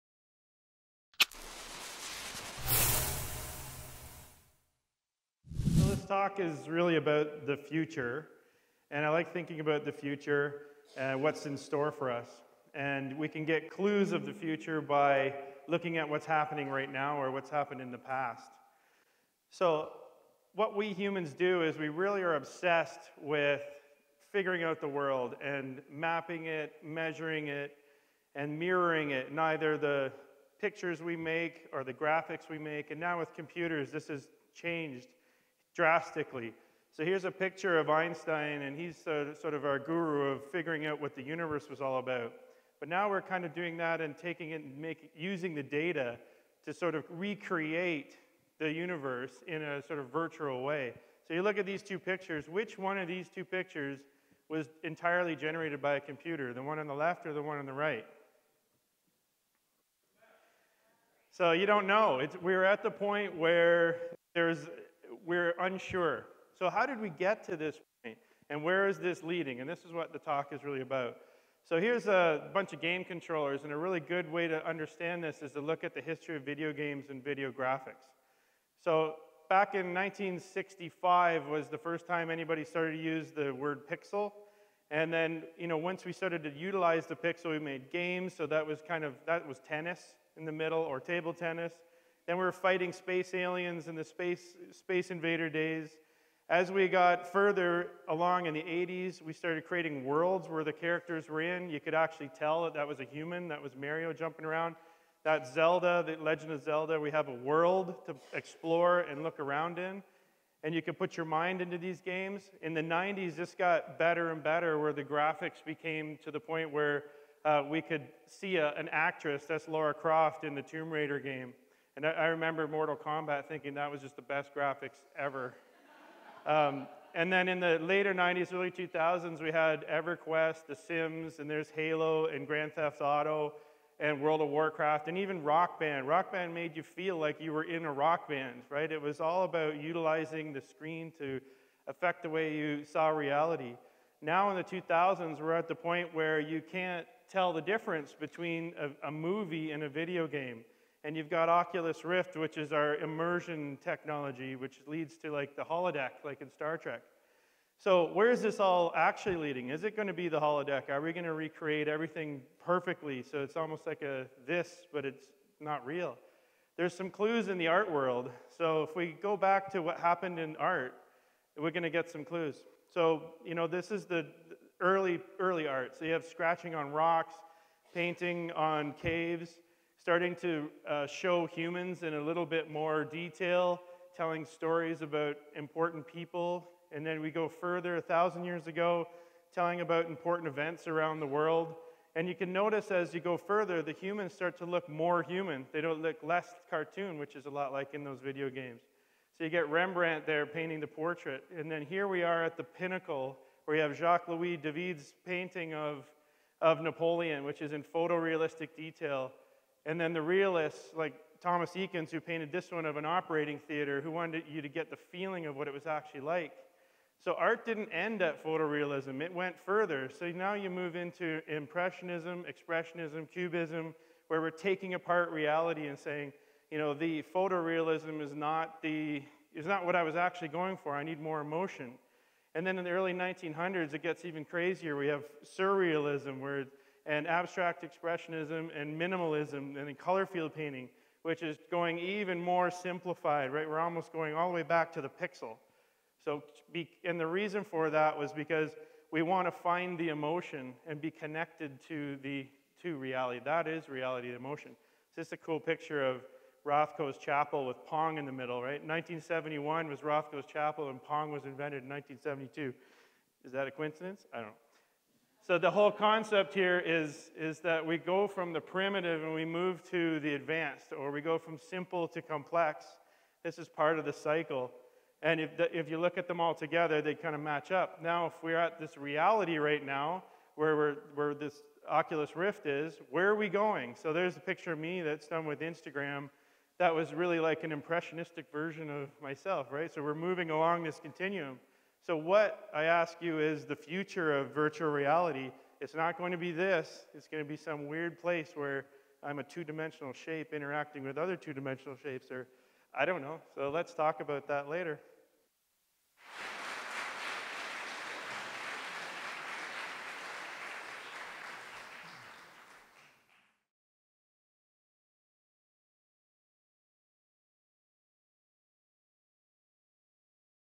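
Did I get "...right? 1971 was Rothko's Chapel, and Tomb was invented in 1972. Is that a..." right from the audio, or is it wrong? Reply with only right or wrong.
wrong.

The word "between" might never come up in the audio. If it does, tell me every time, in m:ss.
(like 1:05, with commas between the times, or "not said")
2:28.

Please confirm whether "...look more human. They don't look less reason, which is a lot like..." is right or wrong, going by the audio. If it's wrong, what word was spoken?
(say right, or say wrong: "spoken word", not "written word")
wrong: "cartoon", not "reason".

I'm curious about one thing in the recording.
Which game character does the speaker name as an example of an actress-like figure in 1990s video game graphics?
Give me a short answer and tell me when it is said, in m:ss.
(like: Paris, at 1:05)
Laura Croft, at 1:59.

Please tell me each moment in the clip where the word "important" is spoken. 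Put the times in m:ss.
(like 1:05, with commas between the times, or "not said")
3:05, 3:10.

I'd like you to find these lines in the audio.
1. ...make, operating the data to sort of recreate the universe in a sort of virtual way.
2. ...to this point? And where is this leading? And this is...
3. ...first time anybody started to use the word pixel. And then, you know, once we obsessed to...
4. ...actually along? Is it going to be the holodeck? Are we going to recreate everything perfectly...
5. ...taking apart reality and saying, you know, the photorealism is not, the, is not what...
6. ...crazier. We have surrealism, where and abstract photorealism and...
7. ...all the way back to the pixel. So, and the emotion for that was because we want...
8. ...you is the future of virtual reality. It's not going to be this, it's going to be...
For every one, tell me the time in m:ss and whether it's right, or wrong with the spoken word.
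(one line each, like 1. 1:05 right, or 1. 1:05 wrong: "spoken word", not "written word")
1. 0:44 wrong: "using", not "operating"
2. 1:07 right
3. 1:21 wrong: "started", not "obsessed"
4. 2:38 wrong: "leading", not "along"
5. 3:44 right
6. 3:54 wrong: "expressionism", not "photorealism"
7. 4:04 wrong: "reason", not "emotion"
8. 4:53 right.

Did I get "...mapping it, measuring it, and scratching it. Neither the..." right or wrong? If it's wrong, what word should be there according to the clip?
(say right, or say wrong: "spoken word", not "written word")
wrong: "mirroring", not "scratching".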